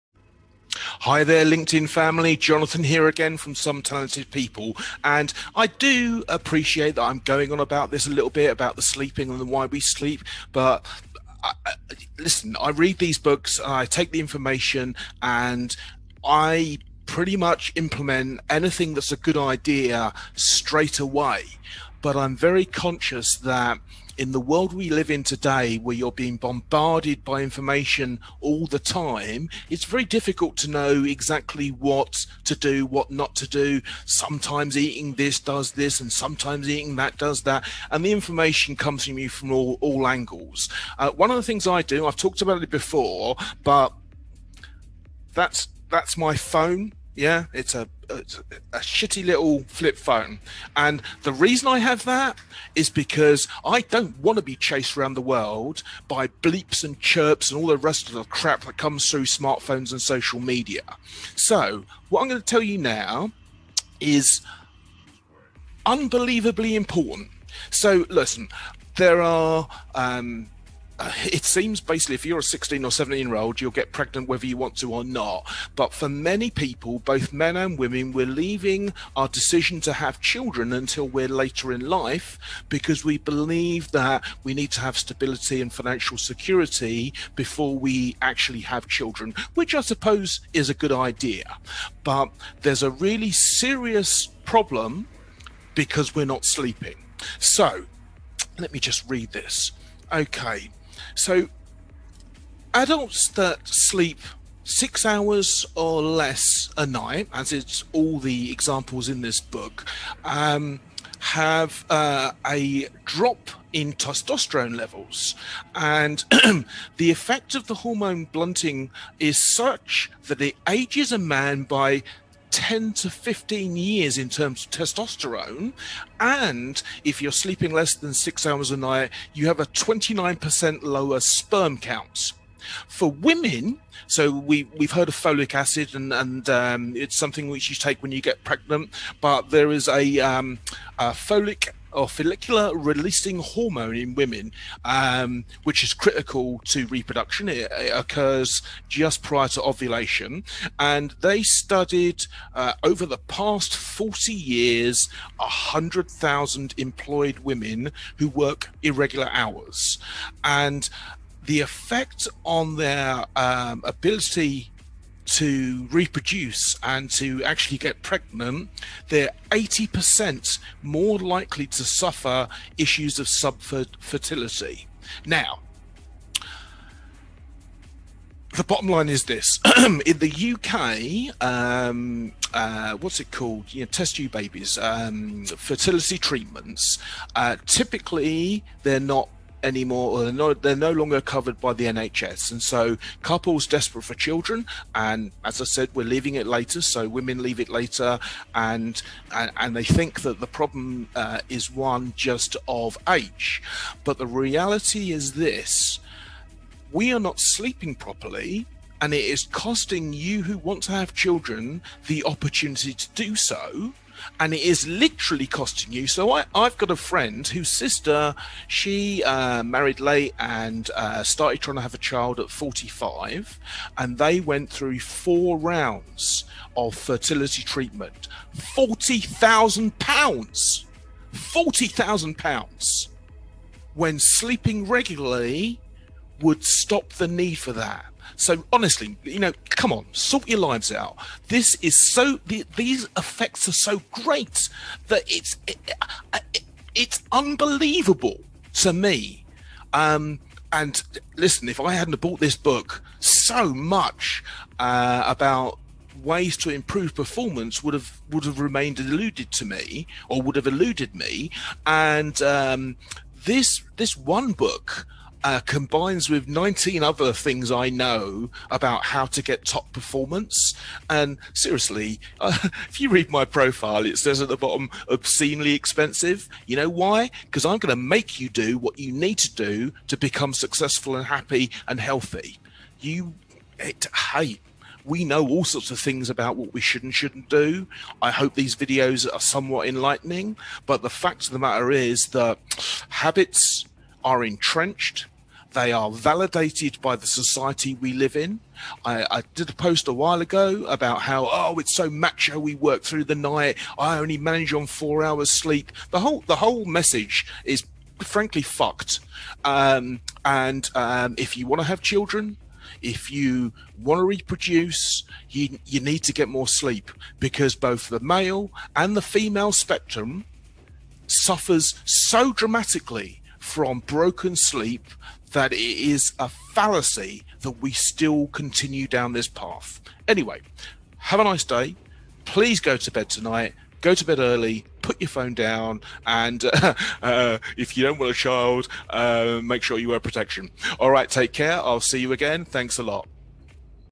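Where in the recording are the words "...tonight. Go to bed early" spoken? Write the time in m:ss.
5:33.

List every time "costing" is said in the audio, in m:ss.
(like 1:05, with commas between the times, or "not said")
3:29, 3:35.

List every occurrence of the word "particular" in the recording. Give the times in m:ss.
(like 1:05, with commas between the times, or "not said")
not said.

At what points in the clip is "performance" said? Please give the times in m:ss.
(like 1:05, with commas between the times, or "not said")
4:17, 4:29.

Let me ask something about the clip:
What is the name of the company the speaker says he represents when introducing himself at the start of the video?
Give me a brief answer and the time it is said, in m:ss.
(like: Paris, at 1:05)
Some Talented People, at 0:03.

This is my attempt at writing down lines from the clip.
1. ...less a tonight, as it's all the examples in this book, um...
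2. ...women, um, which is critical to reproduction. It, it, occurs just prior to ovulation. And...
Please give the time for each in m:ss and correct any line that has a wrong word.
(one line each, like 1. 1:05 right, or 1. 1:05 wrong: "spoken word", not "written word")
1. 1:46 wrong: "night", not "tonight"
2. 2:24 right.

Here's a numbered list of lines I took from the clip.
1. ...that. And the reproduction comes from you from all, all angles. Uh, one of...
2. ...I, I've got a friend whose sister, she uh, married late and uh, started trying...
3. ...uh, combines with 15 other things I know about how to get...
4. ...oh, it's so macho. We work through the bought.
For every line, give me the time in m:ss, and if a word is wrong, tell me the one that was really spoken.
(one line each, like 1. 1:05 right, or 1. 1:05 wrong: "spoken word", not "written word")
1. 0:37 wrong: "information", not "reproduction"
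2. 3:36 right
3. 4:25 wrong: "19", not "15"
4. 5:01 wrong: "night", not "bought".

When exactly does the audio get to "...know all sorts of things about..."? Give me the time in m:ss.
4:45.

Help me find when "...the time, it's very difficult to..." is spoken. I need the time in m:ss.
0:28.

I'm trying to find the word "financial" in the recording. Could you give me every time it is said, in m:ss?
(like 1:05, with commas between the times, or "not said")
1:25.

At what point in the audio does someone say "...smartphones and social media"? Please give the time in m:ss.
0:59.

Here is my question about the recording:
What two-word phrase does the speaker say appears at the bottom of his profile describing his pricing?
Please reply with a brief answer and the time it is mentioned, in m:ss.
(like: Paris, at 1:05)
obscenely expensive, at 4:35.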